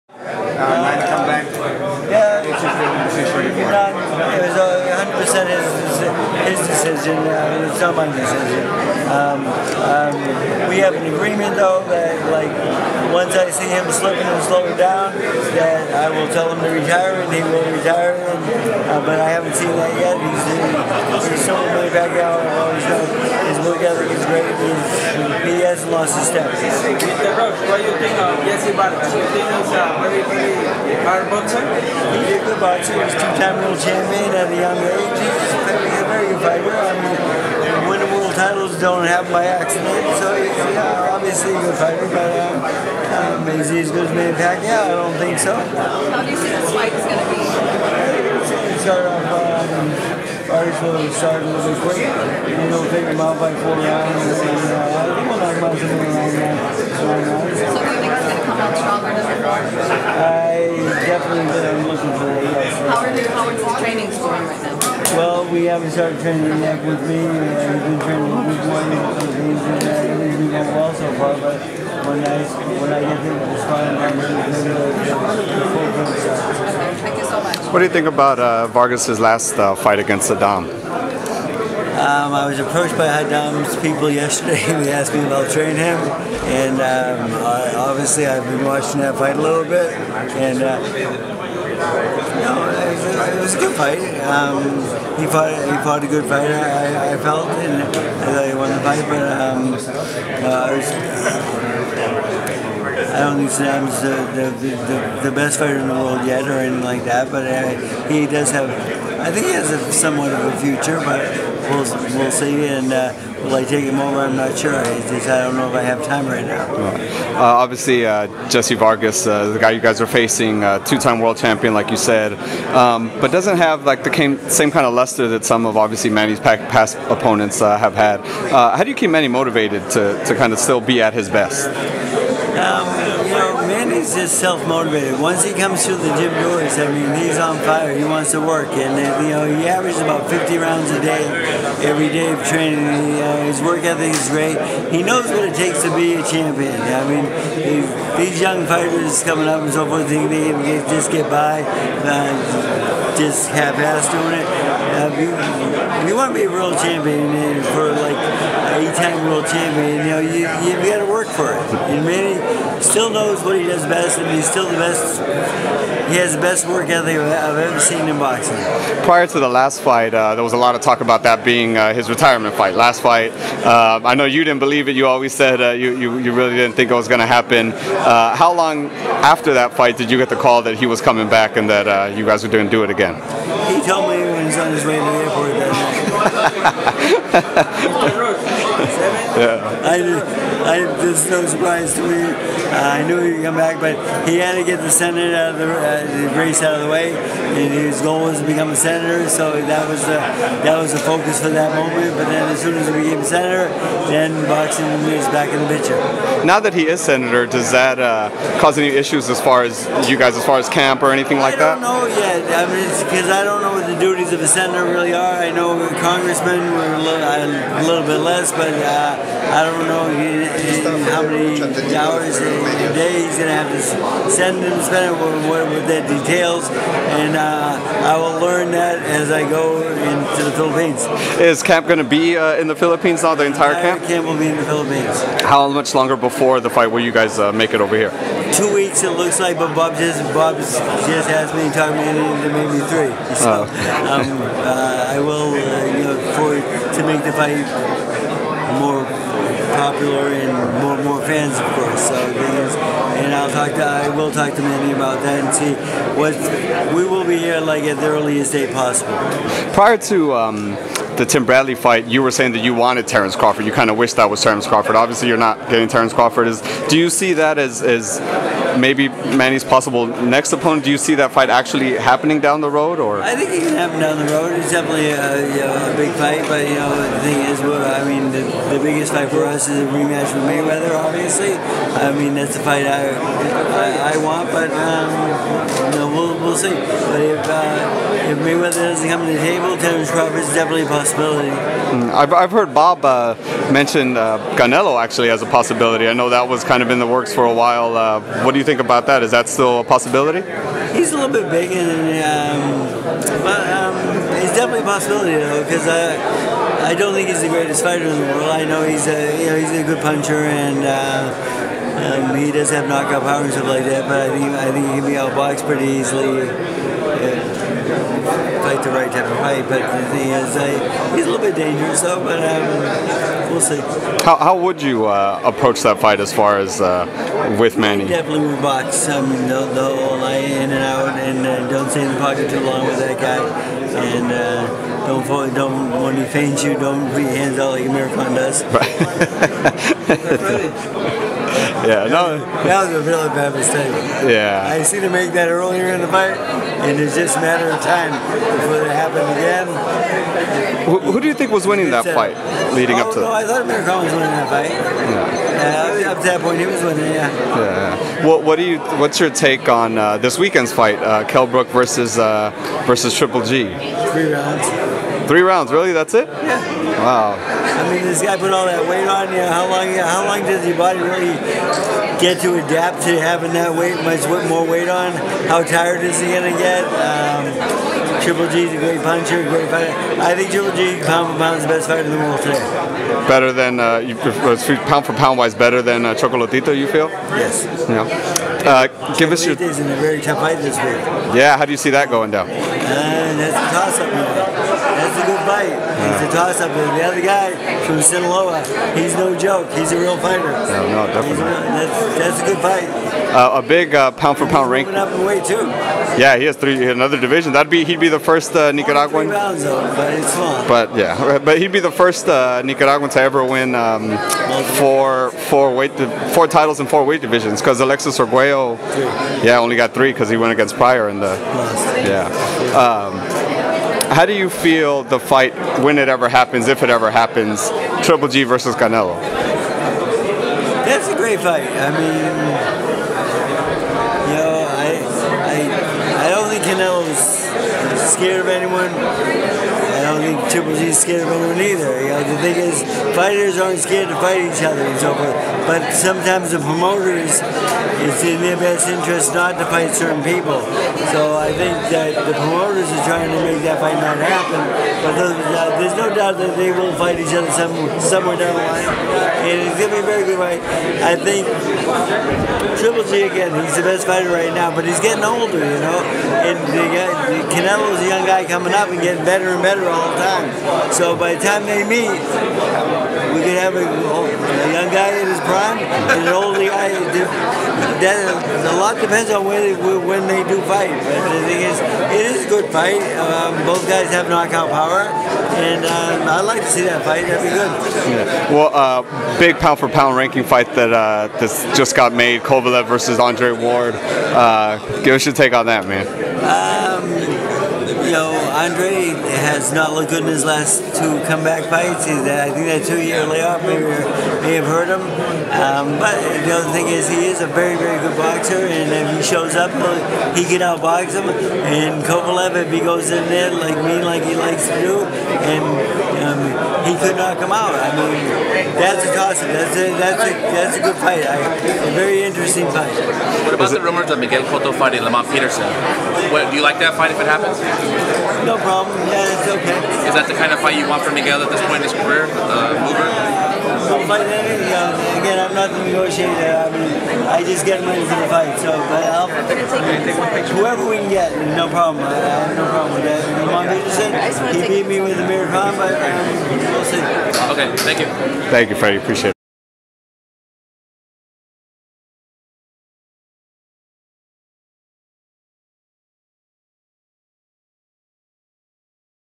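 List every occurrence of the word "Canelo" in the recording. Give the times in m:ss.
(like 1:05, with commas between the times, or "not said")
4:54, 7:08, 7:16, 7:47.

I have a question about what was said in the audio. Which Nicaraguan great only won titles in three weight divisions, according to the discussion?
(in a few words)
Alexis Arguello.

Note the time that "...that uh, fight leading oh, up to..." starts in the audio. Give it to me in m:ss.
5:51.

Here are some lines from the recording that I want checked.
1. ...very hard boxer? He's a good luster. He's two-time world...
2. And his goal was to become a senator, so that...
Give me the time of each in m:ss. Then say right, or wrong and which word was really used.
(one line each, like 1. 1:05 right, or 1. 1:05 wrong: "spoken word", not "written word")
1. 0:30 wrong: "boxer", not "luster"
2. 3:17 right.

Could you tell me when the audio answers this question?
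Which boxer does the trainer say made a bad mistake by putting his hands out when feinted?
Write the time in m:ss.
5:37.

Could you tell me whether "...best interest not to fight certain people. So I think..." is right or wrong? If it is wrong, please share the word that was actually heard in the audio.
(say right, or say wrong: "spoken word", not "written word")
right.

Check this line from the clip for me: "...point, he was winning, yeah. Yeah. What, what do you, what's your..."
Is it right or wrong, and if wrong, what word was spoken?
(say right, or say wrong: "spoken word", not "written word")
right.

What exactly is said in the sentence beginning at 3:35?
I know congressmen were a little, a little bit less, but.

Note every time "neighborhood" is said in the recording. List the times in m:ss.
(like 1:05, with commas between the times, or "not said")
not said.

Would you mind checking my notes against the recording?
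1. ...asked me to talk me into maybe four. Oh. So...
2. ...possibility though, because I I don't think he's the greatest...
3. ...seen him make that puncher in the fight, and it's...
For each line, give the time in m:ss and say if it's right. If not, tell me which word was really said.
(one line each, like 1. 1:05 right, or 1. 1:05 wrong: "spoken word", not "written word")
1. 4:00 wrong: "three", not "four"
2. 5:04 right
3. 5:44 wrong: "earlier", not "puncher".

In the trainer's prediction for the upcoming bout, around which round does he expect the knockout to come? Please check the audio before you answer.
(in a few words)
9.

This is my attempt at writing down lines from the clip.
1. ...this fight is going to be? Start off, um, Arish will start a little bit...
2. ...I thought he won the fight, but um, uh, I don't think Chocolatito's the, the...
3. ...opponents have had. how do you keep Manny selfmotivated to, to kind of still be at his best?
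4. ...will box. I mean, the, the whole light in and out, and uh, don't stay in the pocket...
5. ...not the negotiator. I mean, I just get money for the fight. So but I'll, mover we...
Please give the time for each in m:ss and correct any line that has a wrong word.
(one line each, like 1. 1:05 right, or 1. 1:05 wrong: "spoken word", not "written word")
1. 0:46 right
2. 1:37 wrong: "Sadam", not "Chocolatito"
3. 2:07 wrong: "motivated", not "selfmotivated"
4. 5:28 right
5. 8:55 wrong: "whoever", not "mover".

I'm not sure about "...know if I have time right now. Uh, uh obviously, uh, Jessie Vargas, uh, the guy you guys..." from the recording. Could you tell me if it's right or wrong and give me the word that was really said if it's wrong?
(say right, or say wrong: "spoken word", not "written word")
right.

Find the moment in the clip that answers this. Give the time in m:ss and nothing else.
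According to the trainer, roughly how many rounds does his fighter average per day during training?
2:20.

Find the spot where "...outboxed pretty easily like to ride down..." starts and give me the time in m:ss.
5:15.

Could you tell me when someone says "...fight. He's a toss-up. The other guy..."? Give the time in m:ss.
6:35.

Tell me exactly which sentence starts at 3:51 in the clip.
Is camp going to be uh, in the Philippines now, the entire camp?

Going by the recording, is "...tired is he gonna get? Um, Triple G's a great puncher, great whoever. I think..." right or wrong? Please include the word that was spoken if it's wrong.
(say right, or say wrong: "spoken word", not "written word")
wrong: "fighter", not "whoever".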